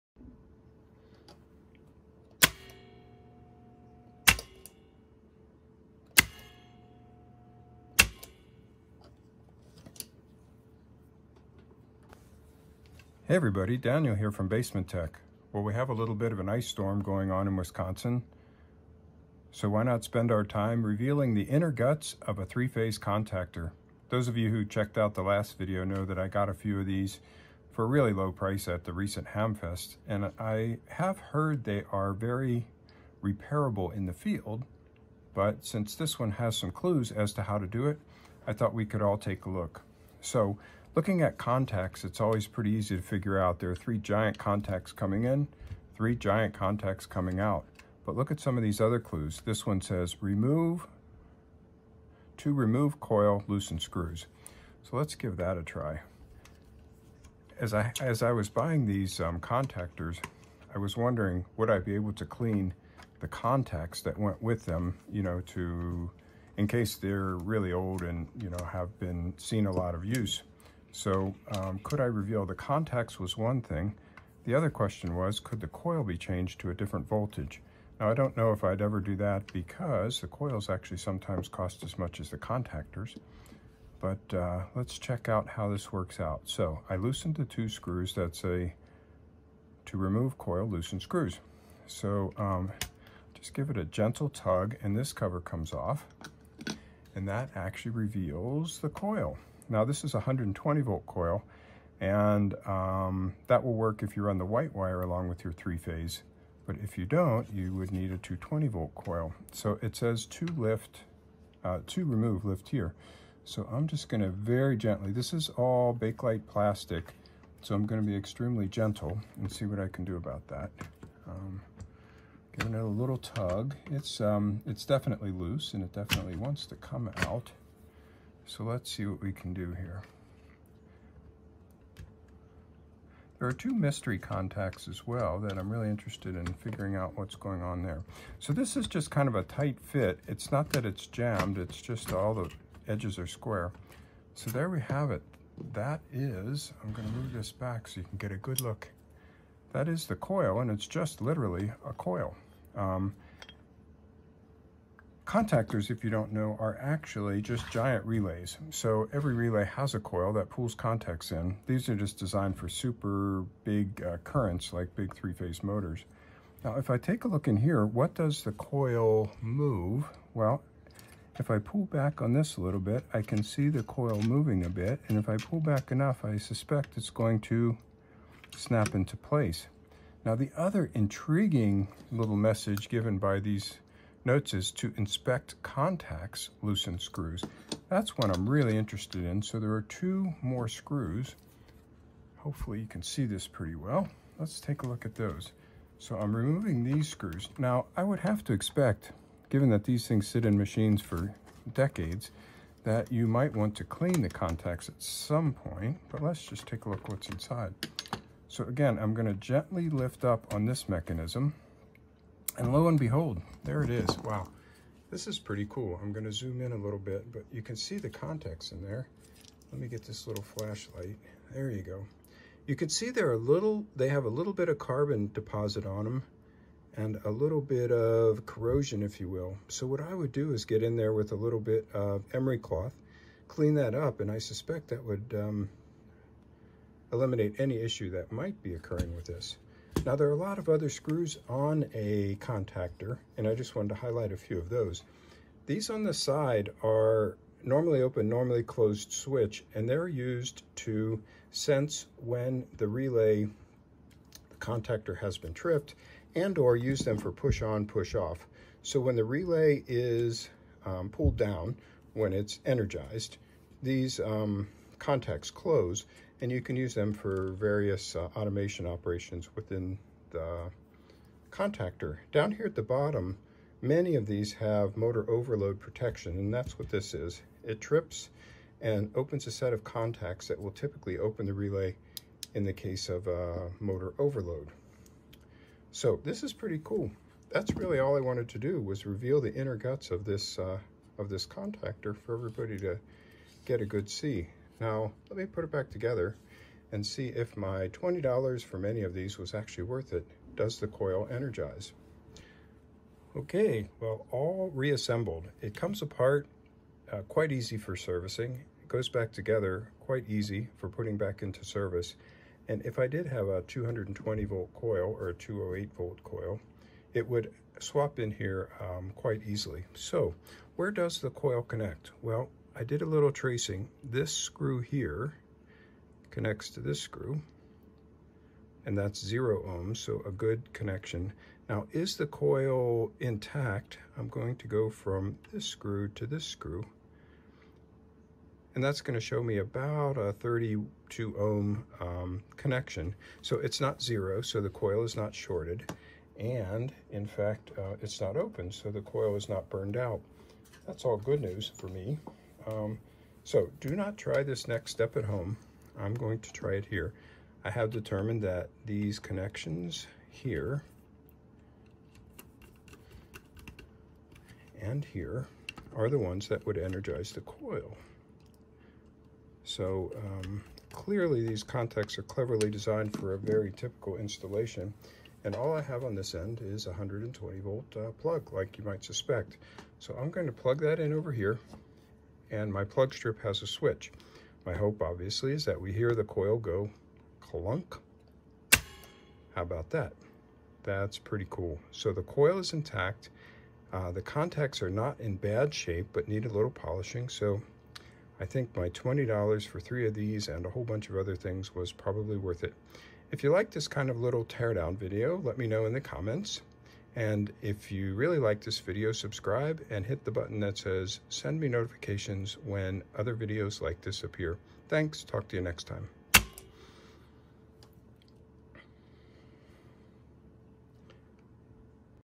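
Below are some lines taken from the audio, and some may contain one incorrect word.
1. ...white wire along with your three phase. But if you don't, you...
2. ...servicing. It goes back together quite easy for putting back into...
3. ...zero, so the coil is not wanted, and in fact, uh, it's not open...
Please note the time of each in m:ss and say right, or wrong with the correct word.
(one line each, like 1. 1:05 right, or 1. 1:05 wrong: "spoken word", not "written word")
1. 1:44 right
2. 5:07 right
3. 5:44 wrong: "shorted", not "wanted".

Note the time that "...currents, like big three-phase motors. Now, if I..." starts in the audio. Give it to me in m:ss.
2:44.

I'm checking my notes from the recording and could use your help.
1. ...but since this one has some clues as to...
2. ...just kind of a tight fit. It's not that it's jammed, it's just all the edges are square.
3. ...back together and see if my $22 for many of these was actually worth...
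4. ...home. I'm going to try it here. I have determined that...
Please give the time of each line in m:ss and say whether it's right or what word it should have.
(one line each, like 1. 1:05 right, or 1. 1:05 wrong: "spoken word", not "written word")
1. 0:35 right
2. 2:18 right
3. 4:55 wrong: "20", not "22"
4. 5:55 right.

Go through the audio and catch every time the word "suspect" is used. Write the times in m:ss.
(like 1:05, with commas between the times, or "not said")
2:56, 3:54, 6:19.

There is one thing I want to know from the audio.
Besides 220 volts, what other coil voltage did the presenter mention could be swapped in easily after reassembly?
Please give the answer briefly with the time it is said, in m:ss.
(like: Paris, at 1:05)
208 volts, at 5:15.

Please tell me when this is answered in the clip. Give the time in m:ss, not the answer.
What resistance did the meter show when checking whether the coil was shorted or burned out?
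5:40.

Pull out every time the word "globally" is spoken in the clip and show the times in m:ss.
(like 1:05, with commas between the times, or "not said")
not said.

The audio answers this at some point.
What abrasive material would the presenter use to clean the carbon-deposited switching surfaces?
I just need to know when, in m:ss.
3:52.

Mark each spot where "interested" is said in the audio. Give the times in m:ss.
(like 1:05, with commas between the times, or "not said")
2:15, 3:08.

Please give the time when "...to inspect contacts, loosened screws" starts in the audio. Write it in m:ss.
3:04.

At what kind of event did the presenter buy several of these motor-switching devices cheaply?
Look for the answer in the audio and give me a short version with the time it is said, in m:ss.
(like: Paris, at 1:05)
Hamfest, at 0:29.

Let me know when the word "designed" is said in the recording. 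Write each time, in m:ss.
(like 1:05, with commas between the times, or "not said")
2:42, 6:12.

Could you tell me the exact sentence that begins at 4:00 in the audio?
Now there are a lot of other screws on a contactor, and I just wanted to highlight a few of those.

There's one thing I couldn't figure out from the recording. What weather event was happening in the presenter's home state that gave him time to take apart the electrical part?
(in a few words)
ice storm.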